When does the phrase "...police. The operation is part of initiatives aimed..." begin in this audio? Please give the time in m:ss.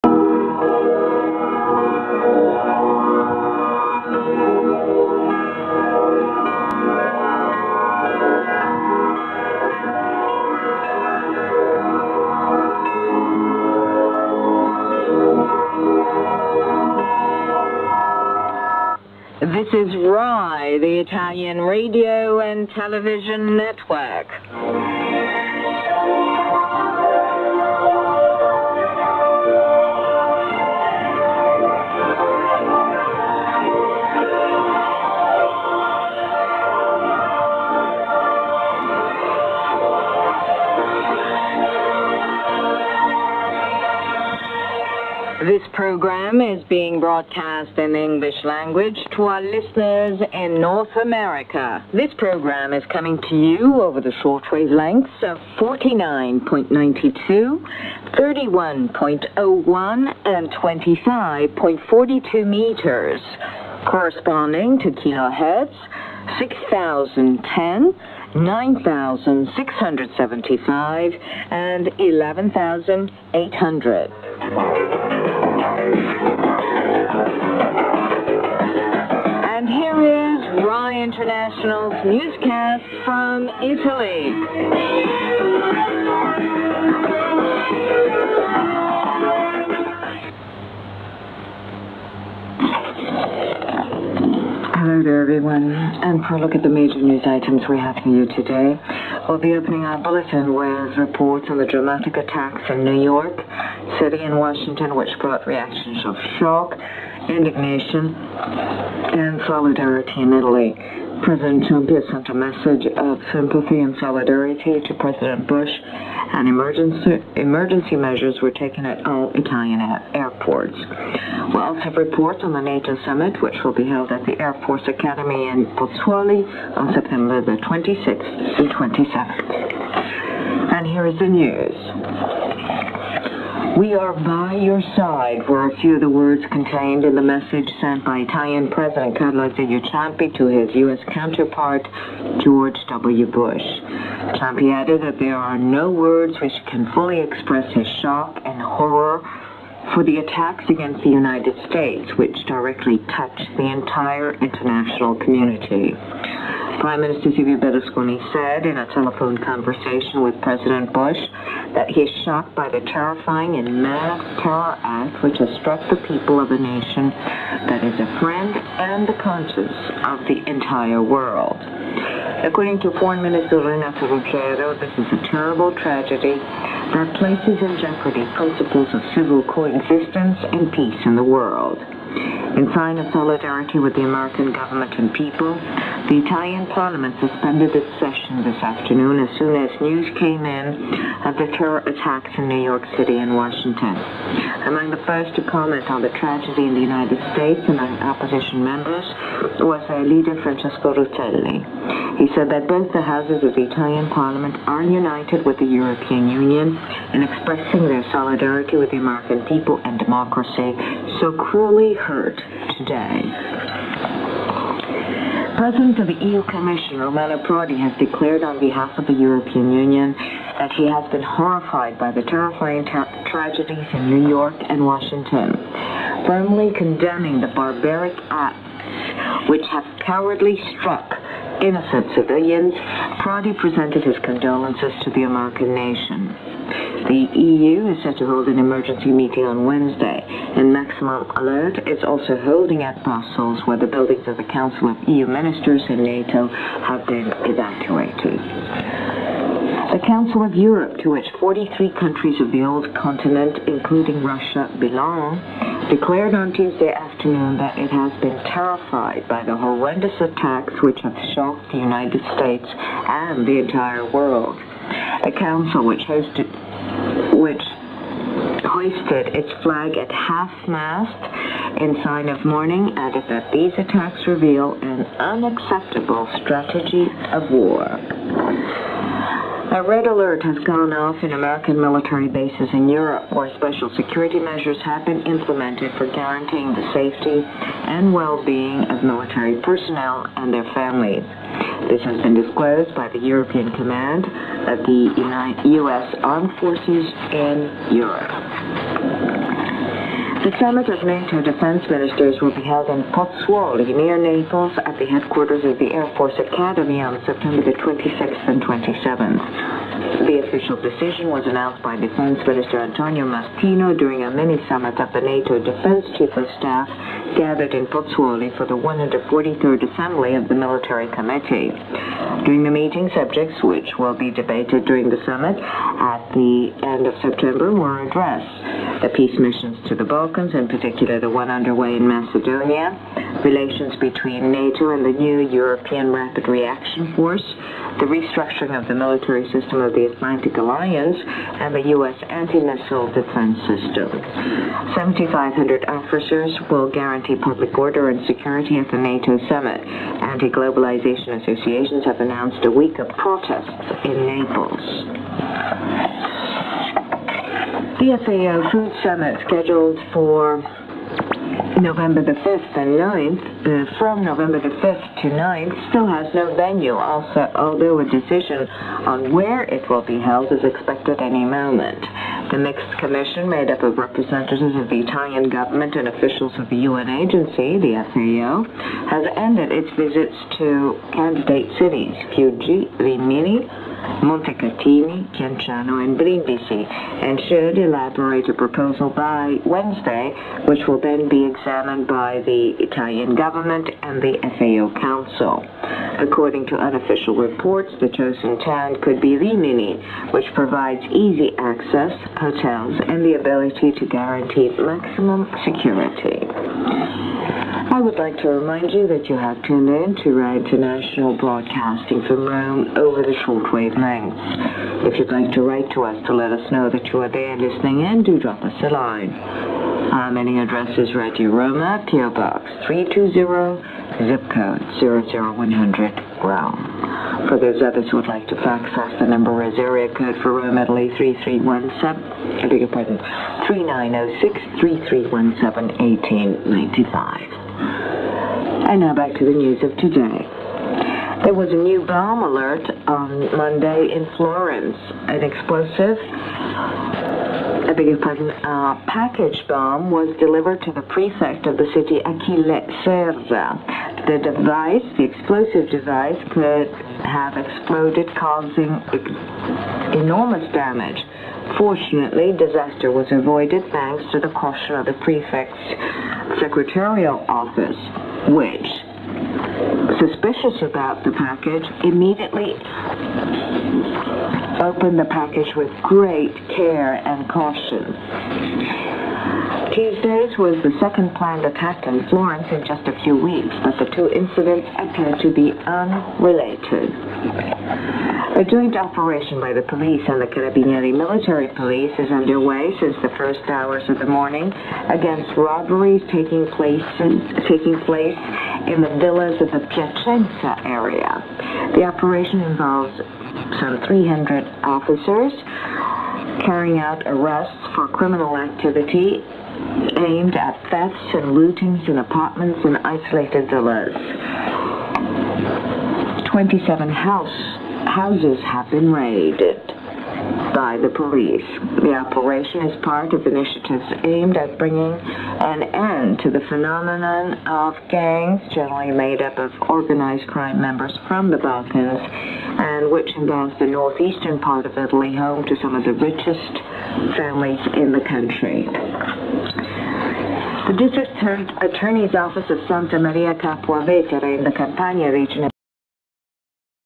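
8:41.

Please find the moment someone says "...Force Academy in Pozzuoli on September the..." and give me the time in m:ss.
2:04.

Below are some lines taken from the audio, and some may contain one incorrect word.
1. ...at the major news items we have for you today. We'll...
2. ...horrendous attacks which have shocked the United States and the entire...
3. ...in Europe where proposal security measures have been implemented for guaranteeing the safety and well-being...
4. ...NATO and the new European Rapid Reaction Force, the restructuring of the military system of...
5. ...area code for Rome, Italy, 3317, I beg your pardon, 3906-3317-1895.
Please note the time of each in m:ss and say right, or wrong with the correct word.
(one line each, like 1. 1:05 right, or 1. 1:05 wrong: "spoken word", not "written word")
1. 1:36 right
2. 4:19 right
3. 4:42 wrong: "special", not "proposal"
4. 5:34 right
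5. 7:09 right.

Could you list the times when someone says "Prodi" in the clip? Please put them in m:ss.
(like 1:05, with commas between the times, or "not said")
3:37, 3:53.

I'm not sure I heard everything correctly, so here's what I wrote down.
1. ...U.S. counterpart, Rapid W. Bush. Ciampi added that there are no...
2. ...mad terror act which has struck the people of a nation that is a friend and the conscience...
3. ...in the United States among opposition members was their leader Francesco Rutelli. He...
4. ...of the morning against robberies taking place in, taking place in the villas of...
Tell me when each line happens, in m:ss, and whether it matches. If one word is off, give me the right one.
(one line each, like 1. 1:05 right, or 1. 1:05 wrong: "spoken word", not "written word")
1. 2:20 wrong: "George", not "Rapid"
2. 2:43 right
3. 3:16 right
4. 8:14 right.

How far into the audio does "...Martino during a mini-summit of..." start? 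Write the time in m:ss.
5:13.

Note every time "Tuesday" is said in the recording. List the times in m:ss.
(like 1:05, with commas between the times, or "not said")
4:16, 7:59.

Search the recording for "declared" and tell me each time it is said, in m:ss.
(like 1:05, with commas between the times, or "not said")
3:37, 4:15.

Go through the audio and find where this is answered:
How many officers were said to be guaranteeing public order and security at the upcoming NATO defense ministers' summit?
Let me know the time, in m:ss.
5:44.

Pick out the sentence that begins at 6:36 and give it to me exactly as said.
According to unofficial reports, the chosen town could be Rimini, which provides easy access, hotels, and the ability to guarantee maximum security.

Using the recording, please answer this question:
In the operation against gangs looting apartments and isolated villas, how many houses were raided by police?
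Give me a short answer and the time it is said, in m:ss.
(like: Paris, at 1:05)
27, at 8:36.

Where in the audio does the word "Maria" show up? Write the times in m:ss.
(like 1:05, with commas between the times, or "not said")
9:03.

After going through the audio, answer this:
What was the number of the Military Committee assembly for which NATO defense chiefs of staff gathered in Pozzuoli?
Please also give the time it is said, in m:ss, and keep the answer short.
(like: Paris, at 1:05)
143rd, at 5:18.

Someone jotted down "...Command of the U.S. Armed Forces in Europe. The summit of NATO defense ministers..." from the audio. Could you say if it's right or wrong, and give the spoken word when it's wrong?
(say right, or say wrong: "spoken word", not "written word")
right.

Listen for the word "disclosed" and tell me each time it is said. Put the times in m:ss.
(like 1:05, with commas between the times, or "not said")
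4:52.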